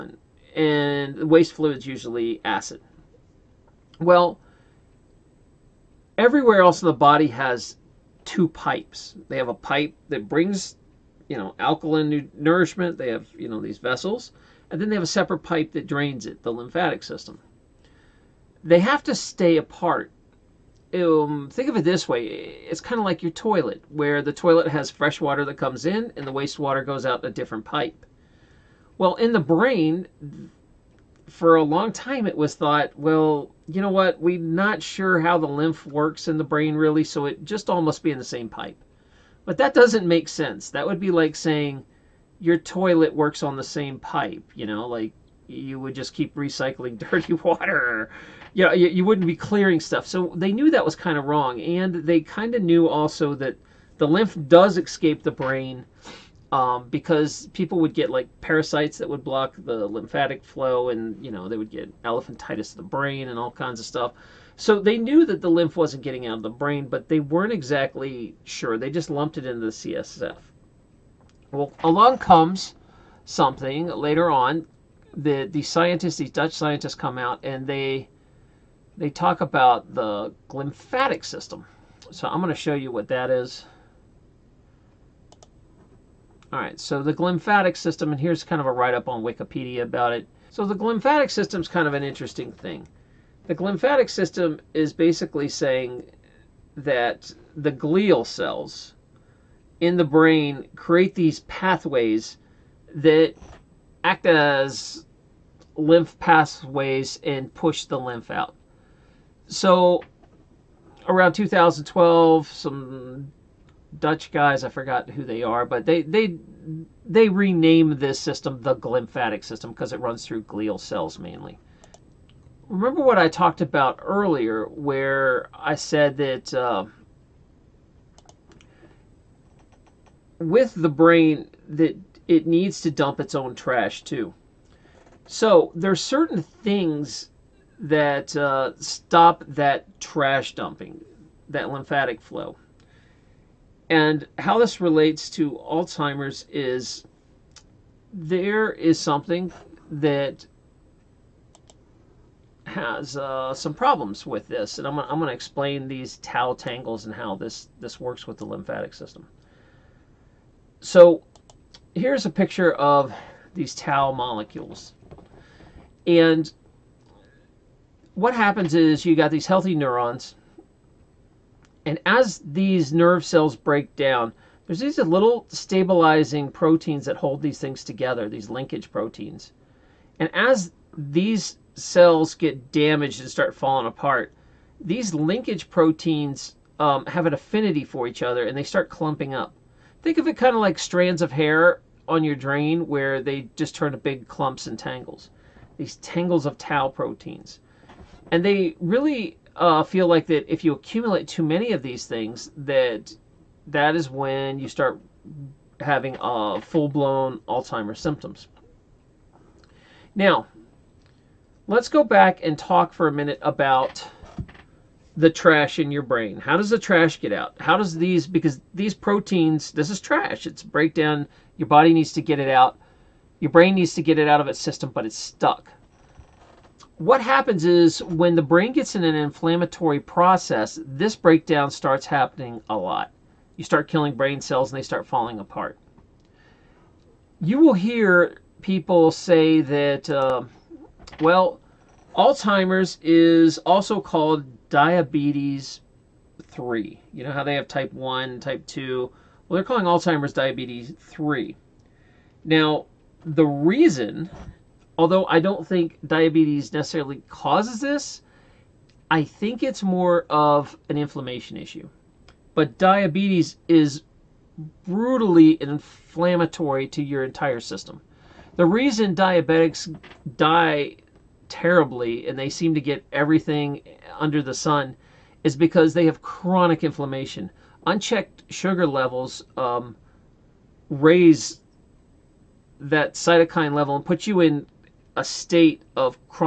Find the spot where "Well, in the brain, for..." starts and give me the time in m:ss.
0:28.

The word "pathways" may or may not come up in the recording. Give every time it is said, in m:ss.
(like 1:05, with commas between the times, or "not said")
1:41, 1:46.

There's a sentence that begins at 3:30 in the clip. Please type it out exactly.
Now, let's go back and talk for a minute about the trash in your brain.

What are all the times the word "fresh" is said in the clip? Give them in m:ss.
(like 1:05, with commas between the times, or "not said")
0:24.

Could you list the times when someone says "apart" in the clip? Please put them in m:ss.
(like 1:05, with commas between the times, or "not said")
0:19, 3:03, 3:55.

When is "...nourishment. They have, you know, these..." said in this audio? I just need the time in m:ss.
0:12.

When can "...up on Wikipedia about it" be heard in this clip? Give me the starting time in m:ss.
1:28.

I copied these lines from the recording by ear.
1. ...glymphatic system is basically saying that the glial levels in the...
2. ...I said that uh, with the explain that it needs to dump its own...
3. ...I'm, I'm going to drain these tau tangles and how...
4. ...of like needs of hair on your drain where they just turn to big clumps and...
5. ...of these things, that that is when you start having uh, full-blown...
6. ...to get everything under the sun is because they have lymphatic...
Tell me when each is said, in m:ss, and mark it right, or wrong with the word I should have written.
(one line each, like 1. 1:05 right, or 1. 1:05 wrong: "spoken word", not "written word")
1. 1:33 wrong: "cells", not "levels"
2. 2:05 wrong: "brain", not "explain"
3. 2:34 wrong: "explain", not "drain"
4. 3:10 wrong: "strands", not "needs"
5. 3:21 right
6. 4:32 wrong: "chronic", not "lymphatic".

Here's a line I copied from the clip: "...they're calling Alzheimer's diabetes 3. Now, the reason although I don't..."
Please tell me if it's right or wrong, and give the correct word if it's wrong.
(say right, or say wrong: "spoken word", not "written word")
right.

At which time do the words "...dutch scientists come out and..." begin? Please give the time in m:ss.
1:16.